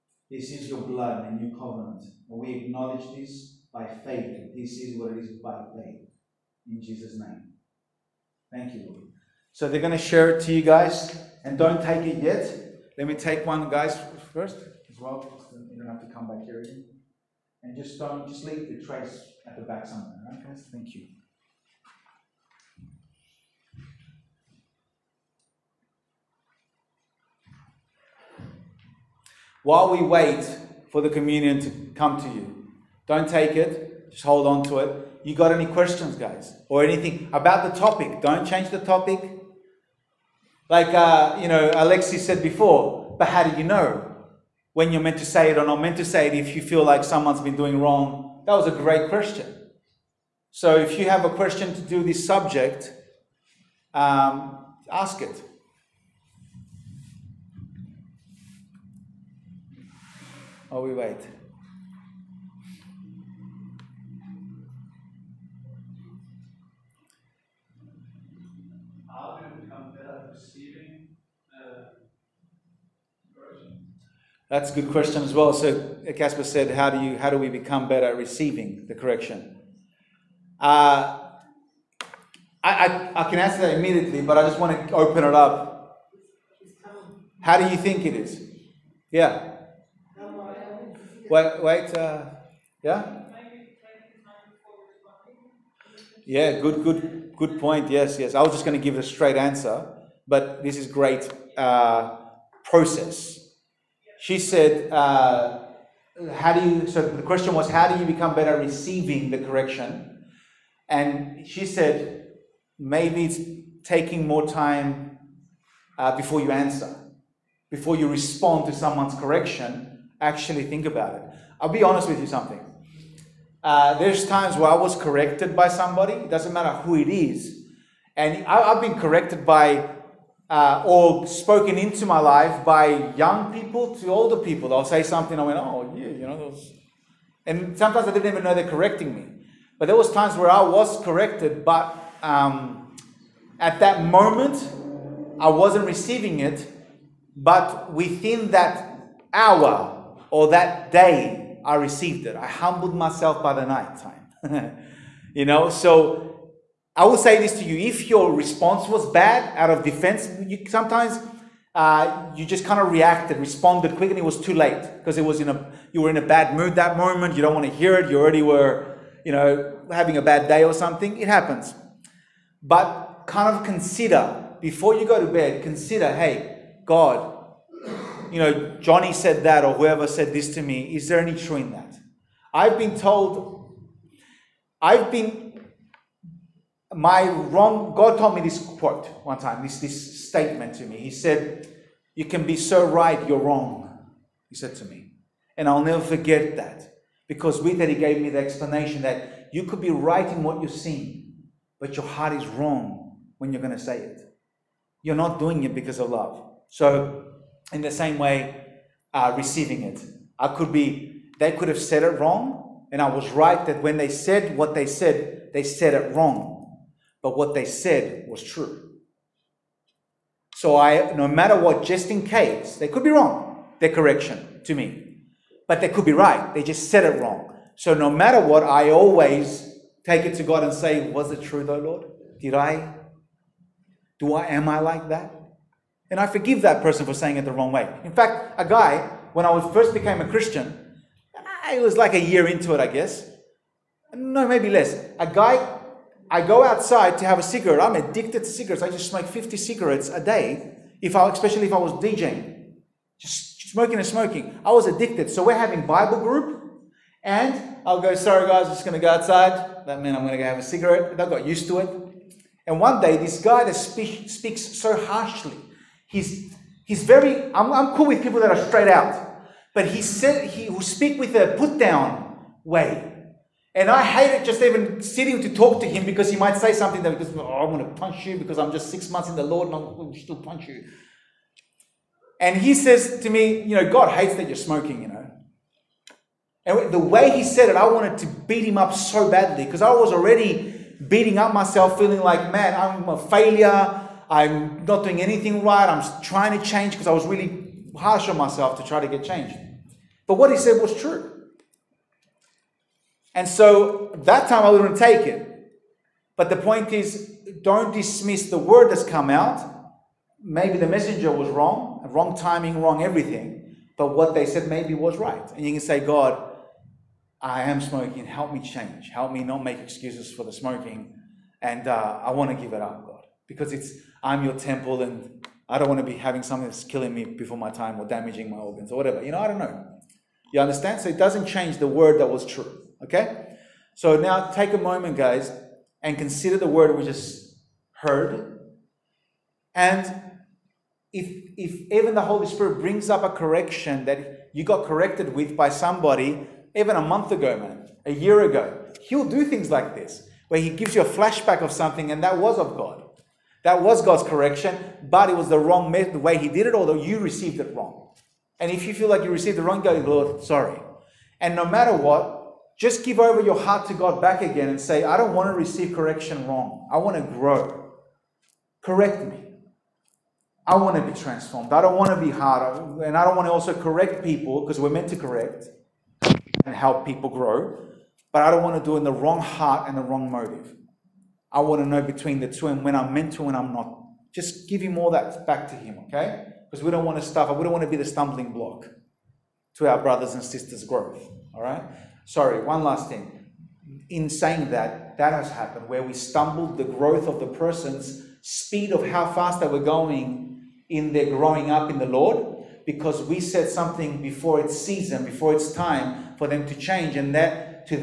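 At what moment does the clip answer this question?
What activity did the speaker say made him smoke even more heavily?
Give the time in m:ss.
4:12.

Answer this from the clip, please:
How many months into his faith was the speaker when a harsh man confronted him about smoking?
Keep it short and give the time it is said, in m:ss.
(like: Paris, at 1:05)
6, at 4:38.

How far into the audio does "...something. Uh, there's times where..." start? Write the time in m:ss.
2:02.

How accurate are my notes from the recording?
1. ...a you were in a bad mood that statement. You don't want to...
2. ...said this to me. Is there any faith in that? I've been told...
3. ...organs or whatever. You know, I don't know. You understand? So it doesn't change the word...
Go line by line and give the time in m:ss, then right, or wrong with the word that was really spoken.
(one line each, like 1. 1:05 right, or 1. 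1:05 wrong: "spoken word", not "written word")
1. 2:45 wrong: "moment", not "statement"
2. 3:00 wrong: "truth", not "faith"
3. 5:28 right.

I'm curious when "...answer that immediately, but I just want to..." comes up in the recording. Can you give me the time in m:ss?
1:23.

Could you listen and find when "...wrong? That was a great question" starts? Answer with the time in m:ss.
0:47.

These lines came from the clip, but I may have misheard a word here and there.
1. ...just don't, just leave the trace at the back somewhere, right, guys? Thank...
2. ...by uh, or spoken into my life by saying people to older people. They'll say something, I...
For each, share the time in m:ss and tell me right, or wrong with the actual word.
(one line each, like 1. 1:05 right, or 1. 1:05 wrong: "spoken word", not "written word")
1. 0:17 right
2. 2:09 wrong: "young", not "saying".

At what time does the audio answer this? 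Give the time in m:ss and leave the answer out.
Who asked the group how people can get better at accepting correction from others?
1:16.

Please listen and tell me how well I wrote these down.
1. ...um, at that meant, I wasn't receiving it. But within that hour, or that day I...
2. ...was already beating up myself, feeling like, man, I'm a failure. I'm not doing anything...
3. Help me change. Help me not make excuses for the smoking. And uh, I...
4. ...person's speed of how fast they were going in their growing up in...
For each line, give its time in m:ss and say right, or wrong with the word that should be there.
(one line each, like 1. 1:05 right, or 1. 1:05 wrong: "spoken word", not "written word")
1. 2:22 wrong: "moment", not "meant"
2. 4:49 right
3. 5:18 right
4. 6:37 right.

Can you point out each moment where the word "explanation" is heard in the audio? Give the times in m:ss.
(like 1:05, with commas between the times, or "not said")
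3:18.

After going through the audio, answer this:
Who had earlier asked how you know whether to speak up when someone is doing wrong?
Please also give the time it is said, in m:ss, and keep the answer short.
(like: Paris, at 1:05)
Alexi, at 0:41.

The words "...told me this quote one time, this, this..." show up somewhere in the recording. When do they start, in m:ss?
3:08.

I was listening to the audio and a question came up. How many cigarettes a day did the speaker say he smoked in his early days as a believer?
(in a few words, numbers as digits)
50.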